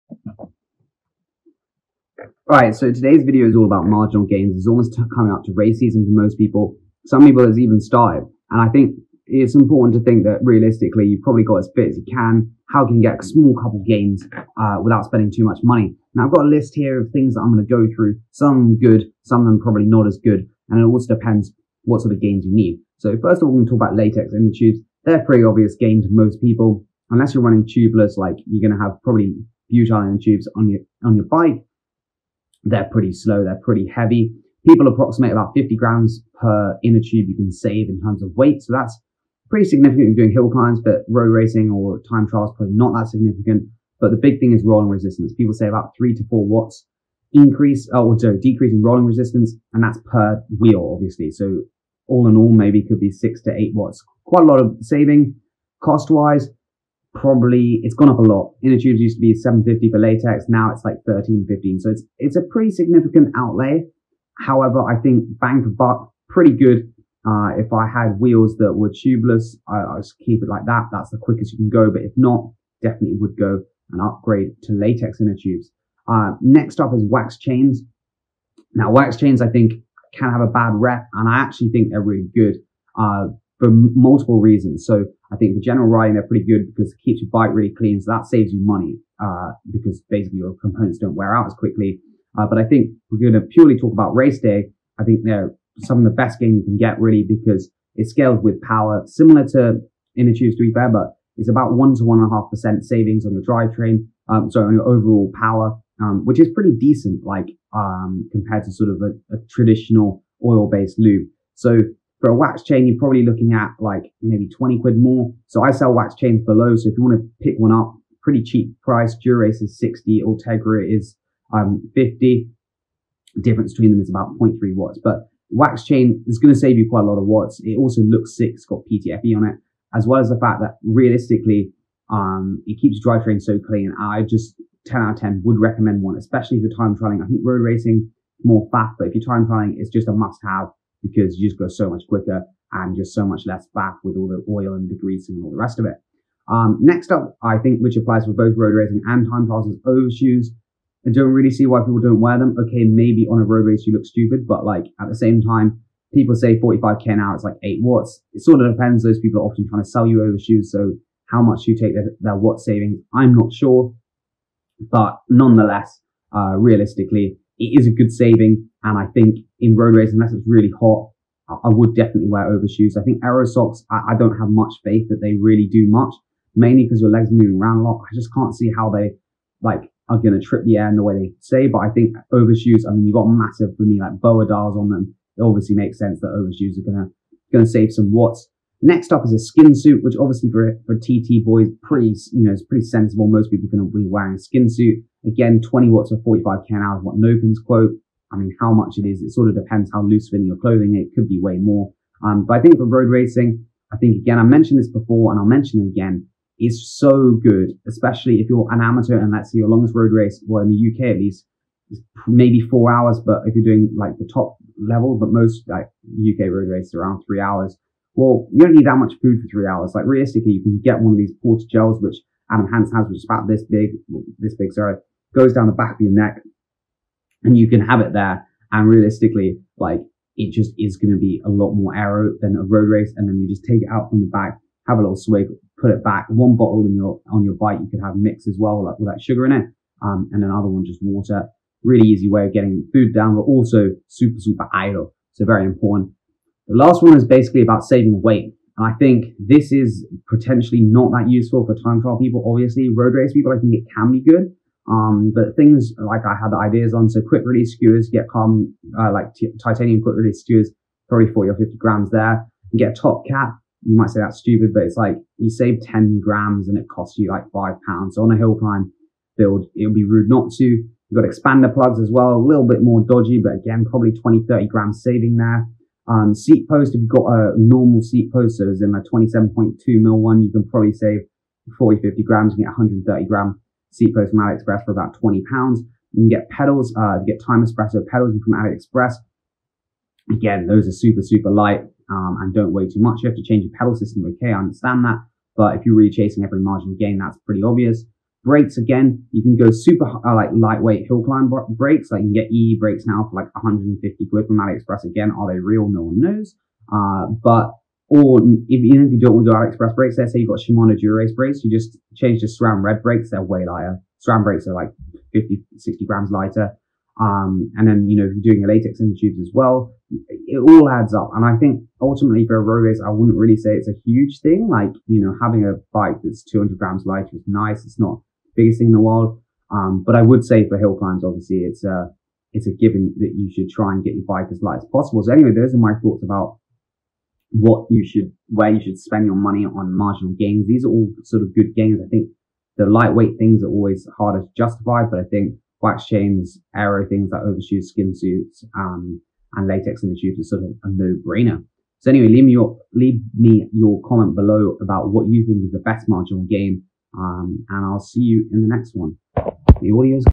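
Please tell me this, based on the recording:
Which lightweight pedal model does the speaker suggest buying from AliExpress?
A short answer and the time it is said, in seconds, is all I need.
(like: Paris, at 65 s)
Time Xpresso, at 287 s.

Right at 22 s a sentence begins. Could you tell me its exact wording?
So first of all, we're going to talk about latex inner tubes.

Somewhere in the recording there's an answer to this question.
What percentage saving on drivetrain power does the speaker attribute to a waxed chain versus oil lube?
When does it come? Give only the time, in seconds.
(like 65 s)
101 s.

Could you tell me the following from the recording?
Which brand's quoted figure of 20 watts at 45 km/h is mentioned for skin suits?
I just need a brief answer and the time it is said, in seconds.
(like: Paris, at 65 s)
Nopinz, at 197 s.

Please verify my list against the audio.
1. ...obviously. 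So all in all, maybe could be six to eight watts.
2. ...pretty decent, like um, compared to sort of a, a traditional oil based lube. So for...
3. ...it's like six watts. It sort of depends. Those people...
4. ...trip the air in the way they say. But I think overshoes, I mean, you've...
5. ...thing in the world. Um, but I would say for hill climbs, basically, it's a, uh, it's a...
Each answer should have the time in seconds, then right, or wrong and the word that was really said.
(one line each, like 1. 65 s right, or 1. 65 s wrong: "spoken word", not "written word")
1. 50 s right
2. 106 s right
3. 157 s wrong: "eight", not "six"
4. 180 s right
5. 328 s wrong: "obviously", not "basically".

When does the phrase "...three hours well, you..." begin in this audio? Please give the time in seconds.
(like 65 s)
217 s.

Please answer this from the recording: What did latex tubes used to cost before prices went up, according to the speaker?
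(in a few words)
7.50.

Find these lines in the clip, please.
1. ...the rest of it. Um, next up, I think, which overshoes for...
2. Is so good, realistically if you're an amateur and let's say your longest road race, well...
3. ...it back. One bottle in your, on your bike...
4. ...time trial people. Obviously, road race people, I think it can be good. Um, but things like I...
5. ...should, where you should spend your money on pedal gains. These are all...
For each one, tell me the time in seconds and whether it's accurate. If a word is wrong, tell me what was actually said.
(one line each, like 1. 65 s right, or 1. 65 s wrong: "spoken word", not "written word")
1. 145 s wrong: "applies", not "overshoes"
2. 206 s wrong: "especially", not "realistically"
3. 235 s right
4. 251 s right
5. 338 s wrong: "marginal", not "pedal".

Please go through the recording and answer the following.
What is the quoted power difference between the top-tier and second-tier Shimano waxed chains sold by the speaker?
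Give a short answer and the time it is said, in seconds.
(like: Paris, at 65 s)
0.3 watts, at 124 s.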